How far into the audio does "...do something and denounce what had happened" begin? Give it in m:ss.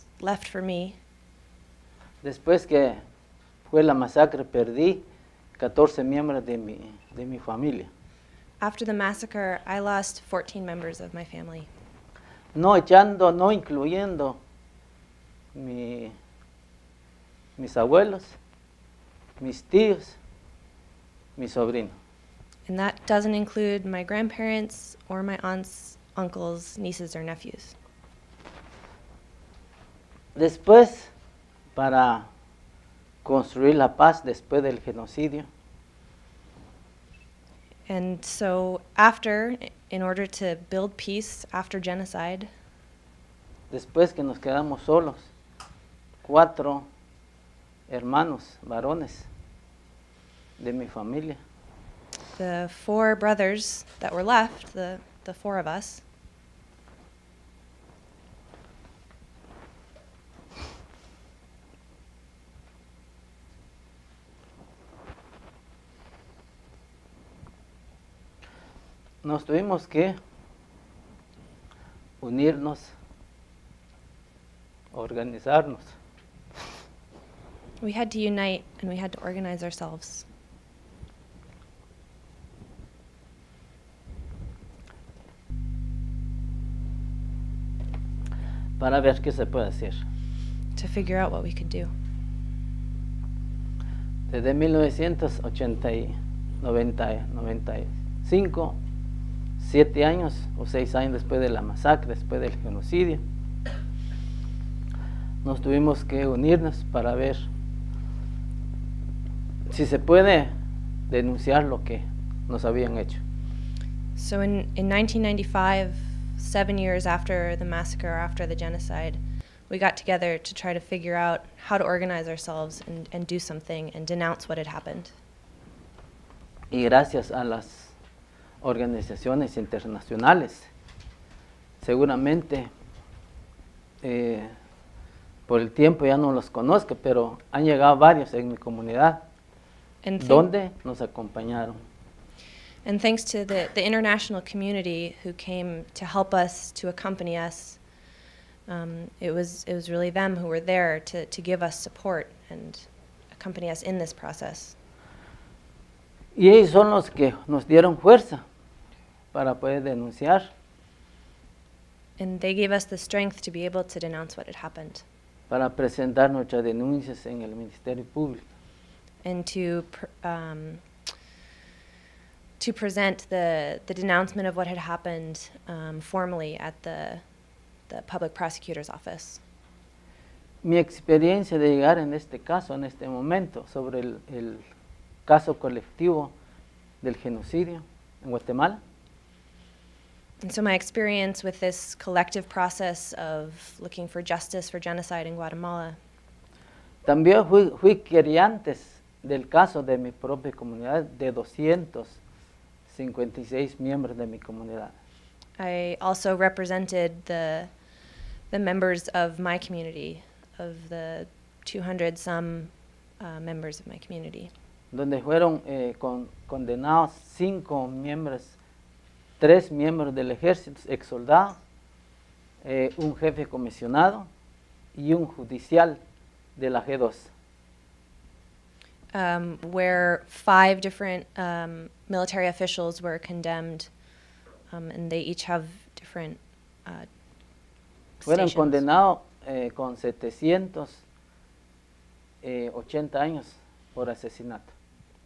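2:03.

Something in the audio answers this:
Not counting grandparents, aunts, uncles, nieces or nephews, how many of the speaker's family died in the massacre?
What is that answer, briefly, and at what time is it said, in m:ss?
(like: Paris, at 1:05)
14, at 0:09.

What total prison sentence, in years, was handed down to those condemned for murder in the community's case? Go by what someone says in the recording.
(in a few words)
780 years.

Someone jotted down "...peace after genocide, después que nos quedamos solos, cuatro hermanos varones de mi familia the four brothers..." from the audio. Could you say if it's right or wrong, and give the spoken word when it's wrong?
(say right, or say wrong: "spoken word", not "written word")
right.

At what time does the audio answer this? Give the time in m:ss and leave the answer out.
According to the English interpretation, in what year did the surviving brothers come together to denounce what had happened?
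1:54.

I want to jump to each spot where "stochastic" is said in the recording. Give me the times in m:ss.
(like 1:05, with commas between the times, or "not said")
not said.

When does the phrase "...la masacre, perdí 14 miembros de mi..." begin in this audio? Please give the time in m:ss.
0:03.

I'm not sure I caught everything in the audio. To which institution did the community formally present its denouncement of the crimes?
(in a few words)
Public prosecutor's office.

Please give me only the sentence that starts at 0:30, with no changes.
Después, para construir la paz después del genocidio.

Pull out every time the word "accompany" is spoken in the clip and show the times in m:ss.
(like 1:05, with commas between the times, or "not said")
2:26, 2:33.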